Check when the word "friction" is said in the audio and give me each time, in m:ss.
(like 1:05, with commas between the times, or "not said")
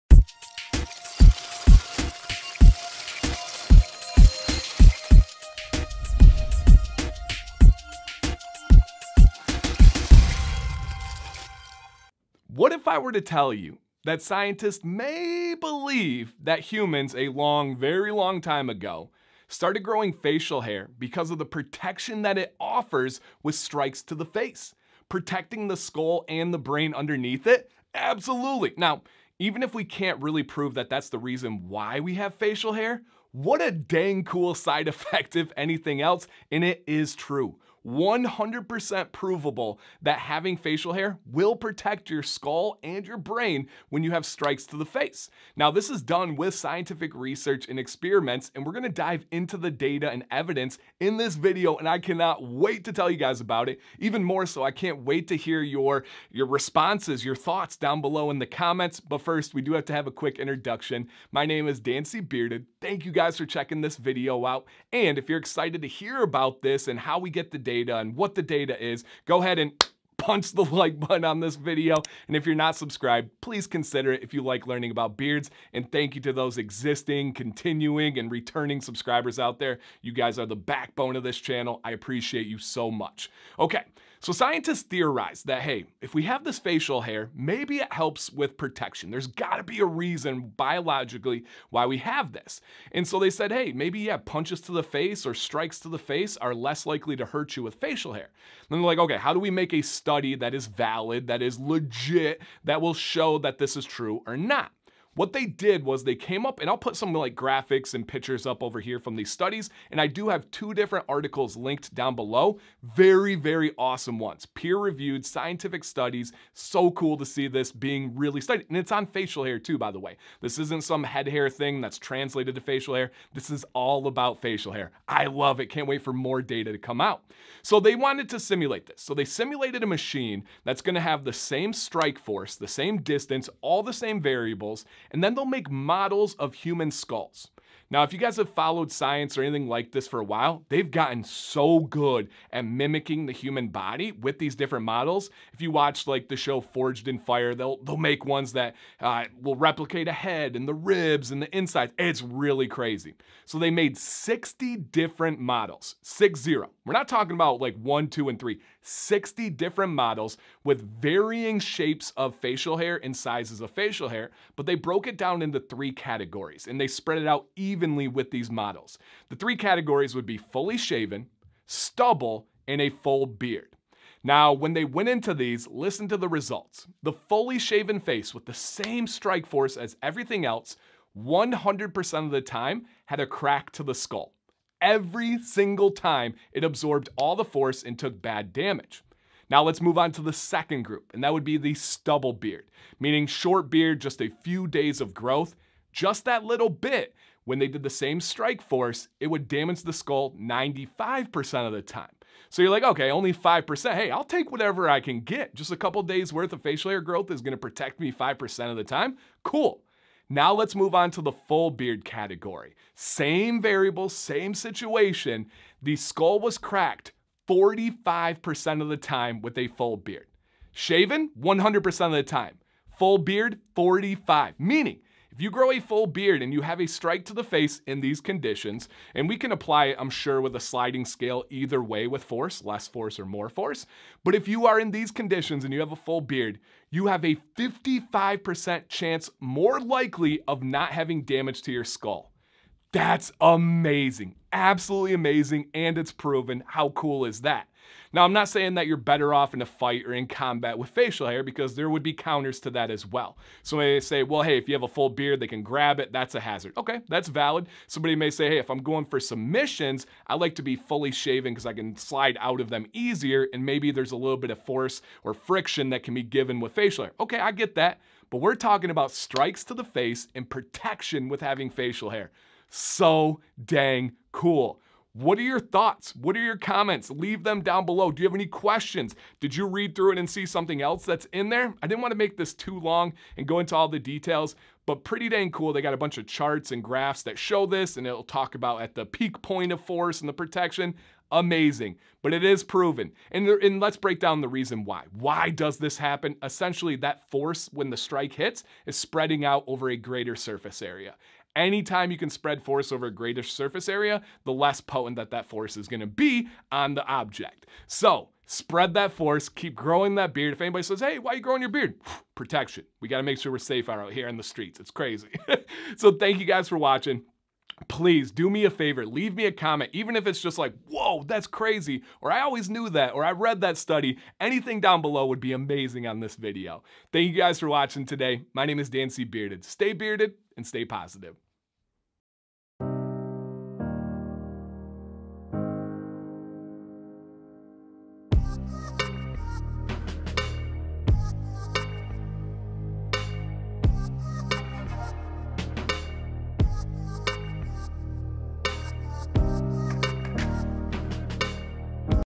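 4:25.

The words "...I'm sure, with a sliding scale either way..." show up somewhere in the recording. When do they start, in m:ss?
3:49.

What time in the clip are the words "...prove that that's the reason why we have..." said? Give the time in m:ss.
0:30.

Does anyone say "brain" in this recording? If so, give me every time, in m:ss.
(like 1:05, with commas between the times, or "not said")
0:26, 0:43.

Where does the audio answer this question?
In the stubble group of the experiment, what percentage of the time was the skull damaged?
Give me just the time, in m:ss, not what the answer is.
3:20.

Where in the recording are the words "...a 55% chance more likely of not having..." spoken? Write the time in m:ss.
3:57.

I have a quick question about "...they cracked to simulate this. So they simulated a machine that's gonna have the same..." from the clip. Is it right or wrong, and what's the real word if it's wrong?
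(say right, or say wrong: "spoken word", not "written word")
wrong: "wanted", not "cracked".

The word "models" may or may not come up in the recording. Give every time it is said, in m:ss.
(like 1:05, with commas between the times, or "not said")
2:15, 2:24, 2:35, 2:39, 2:48.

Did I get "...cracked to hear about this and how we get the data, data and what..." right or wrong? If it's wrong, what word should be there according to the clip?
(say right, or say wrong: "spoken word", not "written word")
wrong: "excited", not "cracked".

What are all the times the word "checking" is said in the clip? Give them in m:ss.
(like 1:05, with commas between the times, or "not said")
1:03.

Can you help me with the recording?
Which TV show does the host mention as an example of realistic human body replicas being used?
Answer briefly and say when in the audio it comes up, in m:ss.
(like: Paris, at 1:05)
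Forged in Fire, at 2:26.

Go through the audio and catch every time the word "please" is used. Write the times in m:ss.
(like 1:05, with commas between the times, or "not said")
1:13, 5:17.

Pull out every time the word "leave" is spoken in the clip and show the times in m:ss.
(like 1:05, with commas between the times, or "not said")
4:37, 5:19.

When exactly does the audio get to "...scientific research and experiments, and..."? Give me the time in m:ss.
0:46.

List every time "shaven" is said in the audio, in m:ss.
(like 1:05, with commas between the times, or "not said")
2:50, 2:57, 3:40, 4:21.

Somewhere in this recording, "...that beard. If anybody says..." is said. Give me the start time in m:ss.
5:10.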